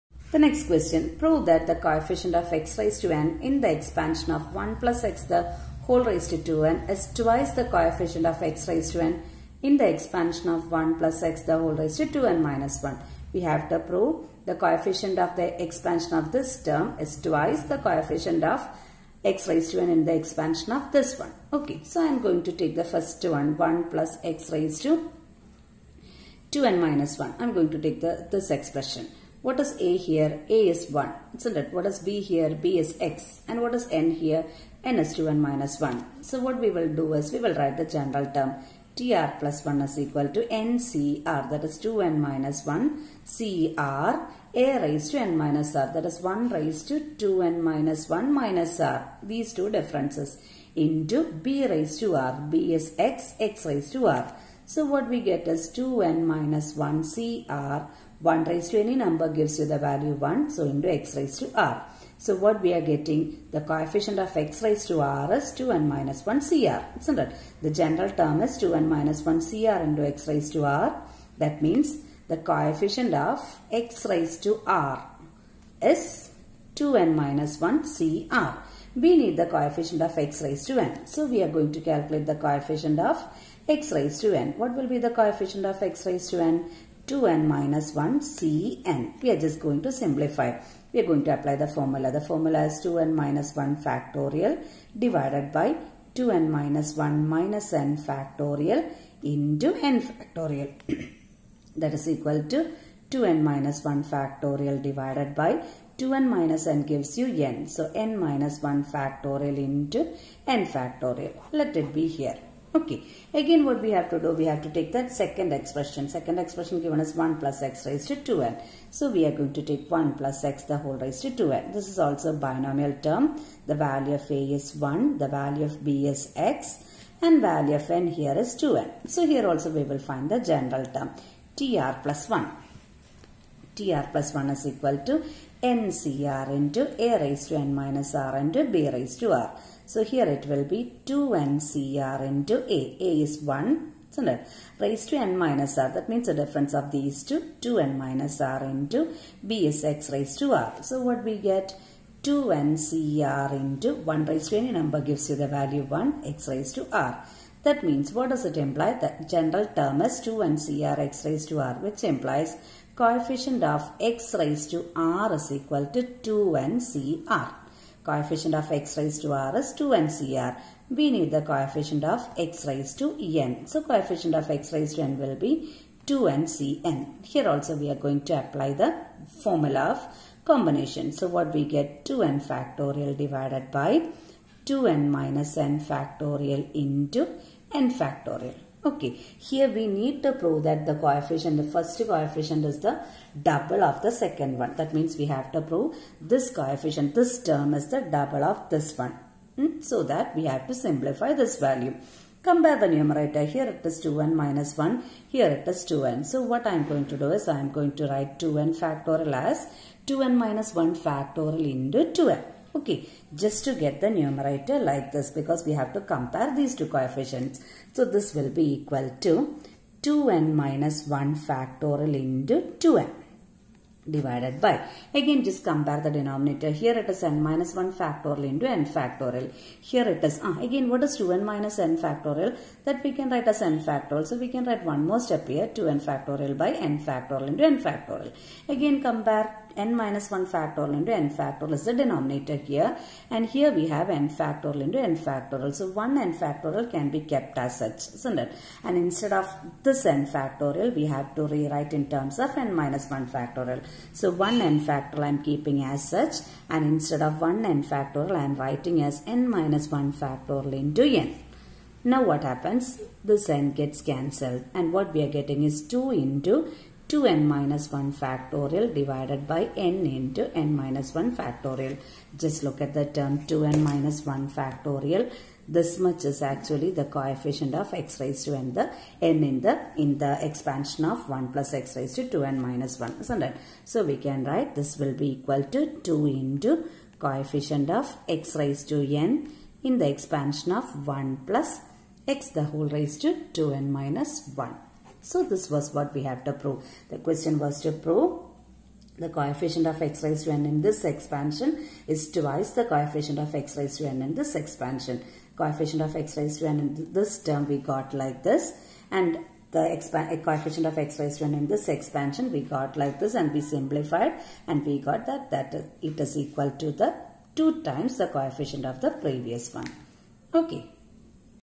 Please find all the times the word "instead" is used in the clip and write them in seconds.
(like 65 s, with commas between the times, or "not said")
248 s, 256 s.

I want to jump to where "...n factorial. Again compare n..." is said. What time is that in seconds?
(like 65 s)
237 s.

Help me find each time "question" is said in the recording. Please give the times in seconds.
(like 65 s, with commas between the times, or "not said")
0 s, 297 s.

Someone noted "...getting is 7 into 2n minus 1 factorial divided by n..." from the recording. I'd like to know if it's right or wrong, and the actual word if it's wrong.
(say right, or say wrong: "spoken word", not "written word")
wrong: "2", not "7".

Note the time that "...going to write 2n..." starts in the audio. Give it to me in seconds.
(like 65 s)
207 s.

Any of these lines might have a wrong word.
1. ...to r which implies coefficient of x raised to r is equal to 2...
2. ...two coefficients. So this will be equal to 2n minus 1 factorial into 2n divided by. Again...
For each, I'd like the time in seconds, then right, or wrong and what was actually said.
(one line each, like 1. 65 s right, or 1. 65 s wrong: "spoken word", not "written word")
1. 161 s right
2. 216 s right.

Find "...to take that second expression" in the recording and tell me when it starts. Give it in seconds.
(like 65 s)
114 s.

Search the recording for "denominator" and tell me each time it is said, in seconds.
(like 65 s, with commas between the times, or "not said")
226 s, 241 s.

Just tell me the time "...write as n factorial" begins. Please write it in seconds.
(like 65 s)
233 s.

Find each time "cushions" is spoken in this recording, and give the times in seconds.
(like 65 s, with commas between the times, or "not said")
not said.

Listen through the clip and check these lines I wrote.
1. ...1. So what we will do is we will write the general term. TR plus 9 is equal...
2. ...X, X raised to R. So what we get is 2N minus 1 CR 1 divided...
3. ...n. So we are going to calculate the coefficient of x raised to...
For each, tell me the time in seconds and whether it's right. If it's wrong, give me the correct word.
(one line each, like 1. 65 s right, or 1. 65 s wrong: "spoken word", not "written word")
1. 35 s wrong: "1", not "9"
2. 52 s wrong: "raised", not "divided"
3. 80 s right.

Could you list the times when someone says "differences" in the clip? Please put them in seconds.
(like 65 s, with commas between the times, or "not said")
49 s, 146 s.